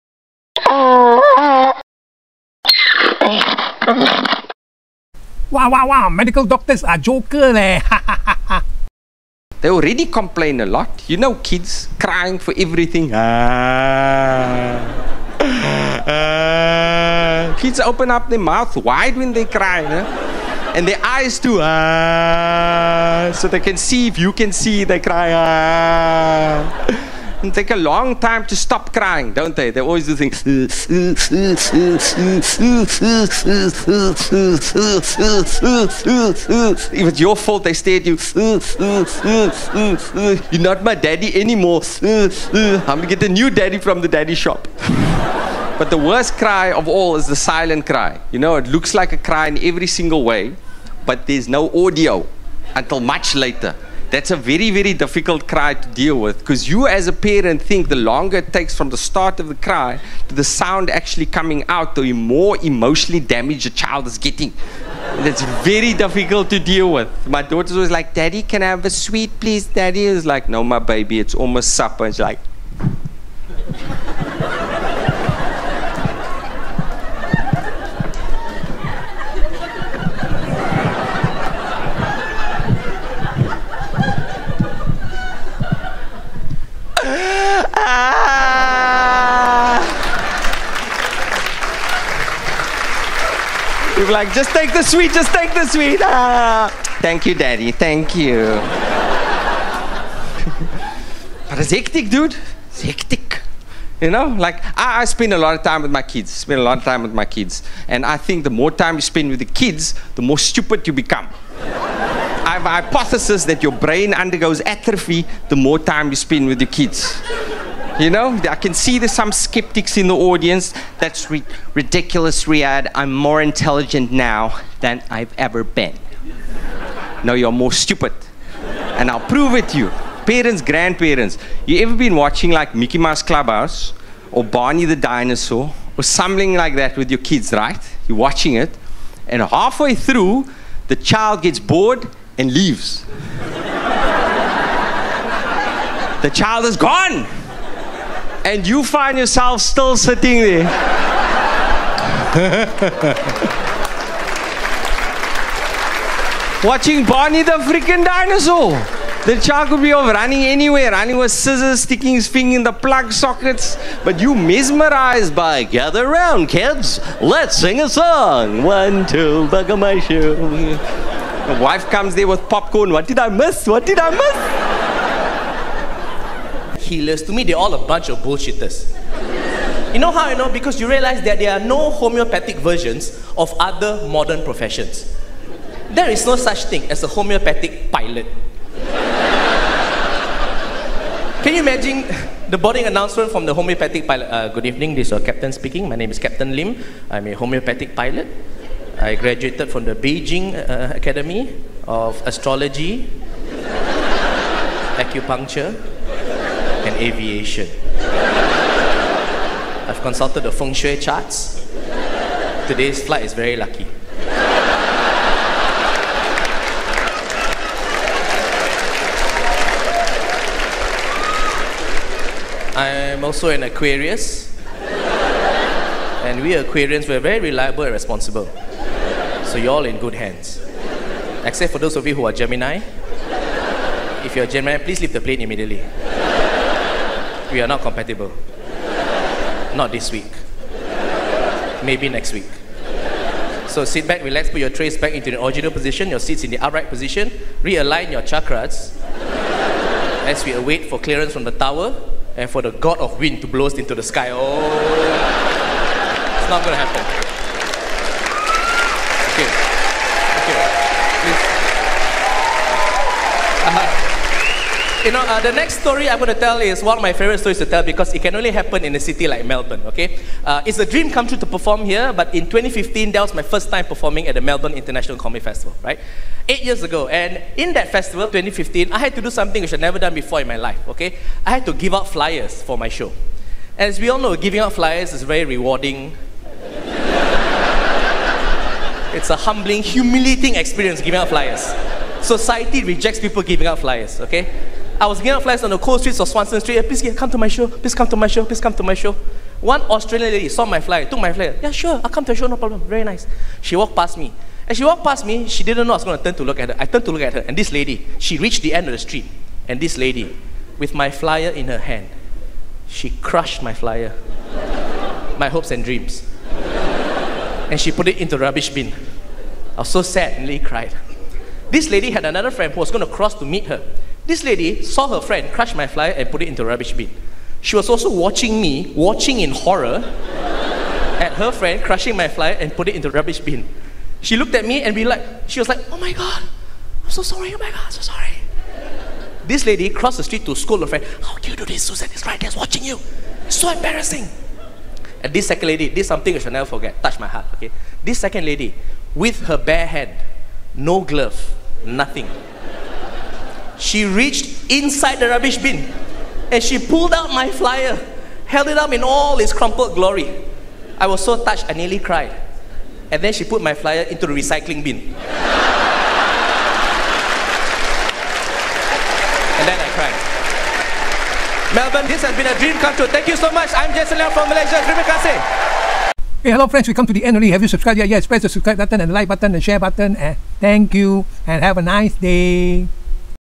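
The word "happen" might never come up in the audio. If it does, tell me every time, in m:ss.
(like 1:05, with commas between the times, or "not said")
4:16, 4:28.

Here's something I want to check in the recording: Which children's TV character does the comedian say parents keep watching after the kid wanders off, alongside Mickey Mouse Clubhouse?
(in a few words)
Barney the Dinosaur.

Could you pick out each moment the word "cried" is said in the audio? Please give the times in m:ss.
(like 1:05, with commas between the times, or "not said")
5:20, 6:01, 6:09.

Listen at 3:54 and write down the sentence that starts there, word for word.
If you're Gemini, please leave the plane immediately we are not compatible.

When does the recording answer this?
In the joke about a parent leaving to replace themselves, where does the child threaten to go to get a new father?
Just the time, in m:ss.
0:44.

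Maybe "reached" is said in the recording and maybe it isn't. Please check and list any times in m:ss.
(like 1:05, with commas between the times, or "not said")
5:08, 5:54.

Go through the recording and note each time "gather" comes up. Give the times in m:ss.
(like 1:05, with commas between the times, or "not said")
2:45.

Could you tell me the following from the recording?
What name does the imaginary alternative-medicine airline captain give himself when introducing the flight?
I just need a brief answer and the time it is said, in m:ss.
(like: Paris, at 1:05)
Captain Lim, at 3:16.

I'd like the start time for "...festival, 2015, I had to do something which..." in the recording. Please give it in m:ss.
4:37.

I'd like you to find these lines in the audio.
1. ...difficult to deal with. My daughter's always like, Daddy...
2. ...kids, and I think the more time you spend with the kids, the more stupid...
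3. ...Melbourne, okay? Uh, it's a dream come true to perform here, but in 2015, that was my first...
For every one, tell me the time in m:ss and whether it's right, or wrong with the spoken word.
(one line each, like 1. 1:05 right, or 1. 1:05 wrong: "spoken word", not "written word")
1. 1:05 right
2. 1:47 right
3. 4:29 right.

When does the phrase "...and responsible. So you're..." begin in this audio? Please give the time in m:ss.
3:47.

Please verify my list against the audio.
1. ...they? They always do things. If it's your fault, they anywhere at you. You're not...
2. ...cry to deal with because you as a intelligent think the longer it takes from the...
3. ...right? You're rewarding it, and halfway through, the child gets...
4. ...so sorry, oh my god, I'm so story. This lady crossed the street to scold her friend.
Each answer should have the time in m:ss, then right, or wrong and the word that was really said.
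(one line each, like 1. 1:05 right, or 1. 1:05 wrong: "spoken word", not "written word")
1. 0:29 wrong: "stare", not "anywhere"
2. 0:55 wrong: "parent", not "intelligent"
3. 2:17 wrong: "watching", not "rewarding"
4. 5:37 wrong: "sorry", not "story".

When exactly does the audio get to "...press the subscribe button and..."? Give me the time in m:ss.
6:18.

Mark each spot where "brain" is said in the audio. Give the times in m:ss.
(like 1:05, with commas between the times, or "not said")
1:53.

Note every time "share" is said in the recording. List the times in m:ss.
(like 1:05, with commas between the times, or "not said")
6:19.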